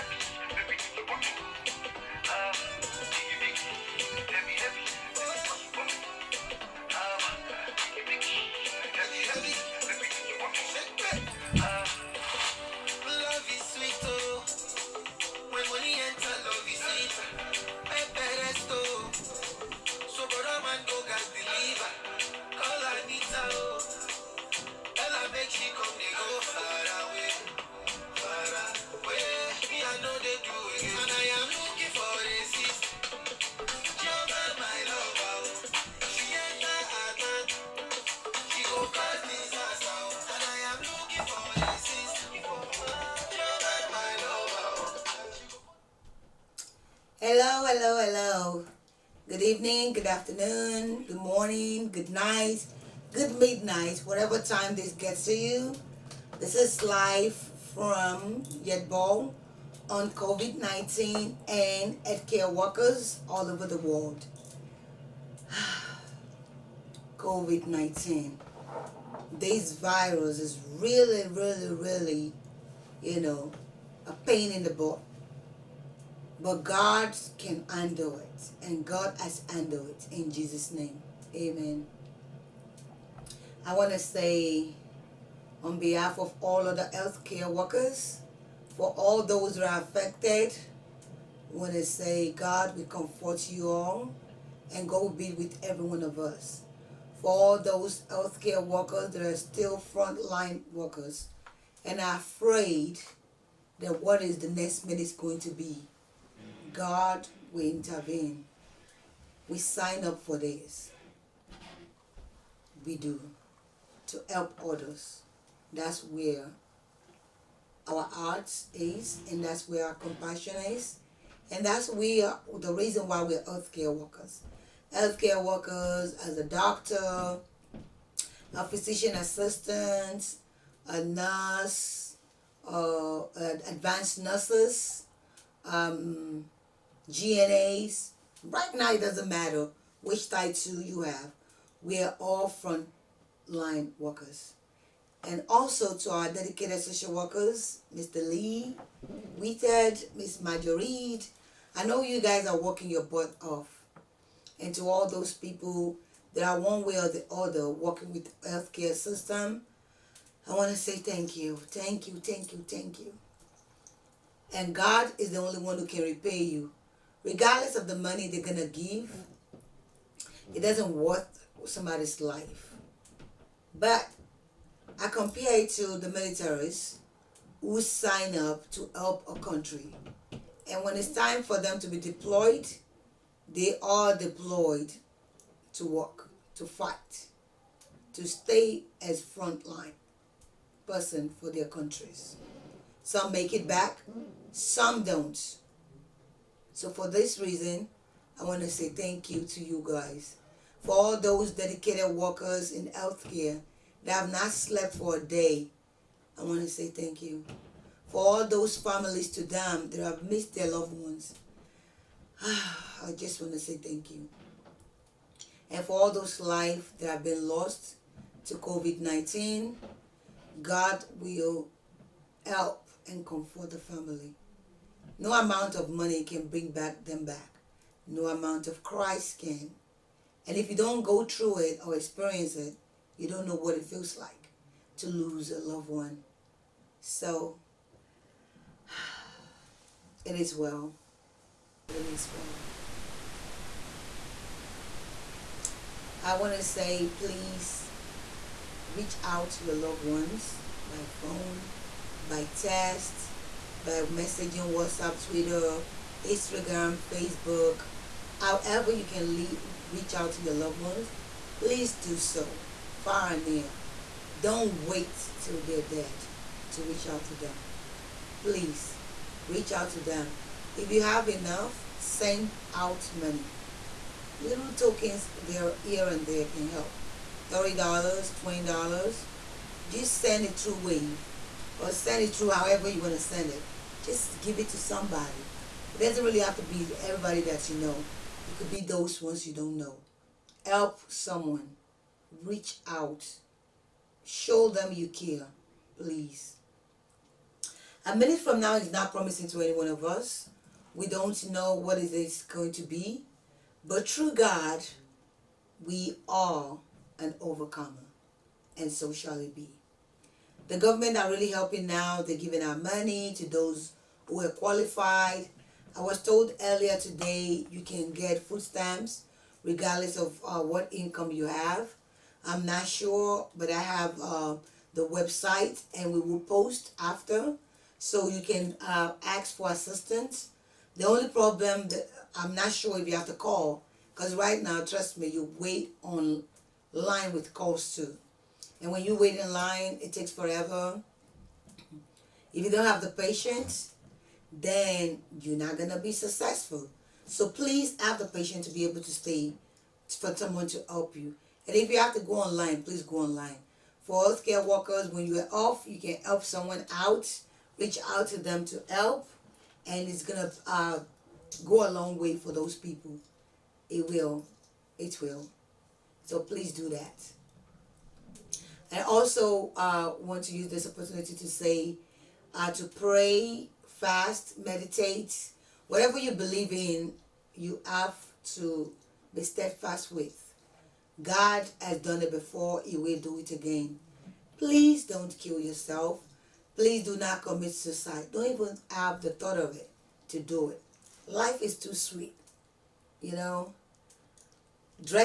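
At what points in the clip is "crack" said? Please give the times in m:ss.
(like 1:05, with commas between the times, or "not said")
not said.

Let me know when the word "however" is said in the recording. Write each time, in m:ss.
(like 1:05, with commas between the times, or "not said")
4:18, 4:42.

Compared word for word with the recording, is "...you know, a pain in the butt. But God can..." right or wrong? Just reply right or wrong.
right.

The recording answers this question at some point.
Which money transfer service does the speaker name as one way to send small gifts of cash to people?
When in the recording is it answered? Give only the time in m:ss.
4:40.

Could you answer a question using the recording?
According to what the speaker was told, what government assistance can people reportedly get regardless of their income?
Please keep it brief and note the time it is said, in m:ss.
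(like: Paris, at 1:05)
Food stamps, at 5:18.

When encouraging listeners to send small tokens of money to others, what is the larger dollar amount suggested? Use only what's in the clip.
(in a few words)
$30.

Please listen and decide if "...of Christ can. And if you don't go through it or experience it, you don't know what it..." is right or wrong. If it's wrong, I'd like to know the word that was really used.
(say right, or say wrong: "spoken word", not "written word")
right.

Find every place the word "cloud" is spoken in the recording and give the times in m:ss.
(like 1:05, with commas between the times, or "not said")
not said.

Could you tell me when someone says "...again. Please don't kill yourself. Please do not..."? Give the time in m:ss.
6:23.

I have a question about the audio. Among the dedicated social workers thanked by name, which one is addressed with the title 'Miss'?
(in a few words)
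Marjorie.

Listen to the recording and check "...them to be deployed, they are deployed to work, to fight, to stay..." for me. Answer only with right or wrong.
right.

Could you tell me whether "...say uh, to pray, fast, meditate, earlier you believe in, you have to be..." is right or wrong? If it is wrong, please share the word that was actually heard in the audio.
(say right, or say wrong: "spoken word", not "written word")
wrong: "whatever", not "earlier".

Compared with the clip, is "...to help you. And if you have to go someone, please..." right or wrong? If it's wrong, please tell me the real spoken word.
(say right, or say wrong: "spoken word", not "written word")
wrong: "online", not "someone".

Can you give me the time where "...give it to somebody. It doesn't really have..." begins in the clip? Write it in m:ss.
4:44.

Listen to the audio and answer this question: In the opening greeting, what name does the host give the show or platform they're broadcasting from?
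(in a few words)
YetBol.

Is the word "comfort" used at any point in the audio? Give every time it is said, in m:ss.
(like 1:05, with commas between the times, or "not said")
1:32, 3:43.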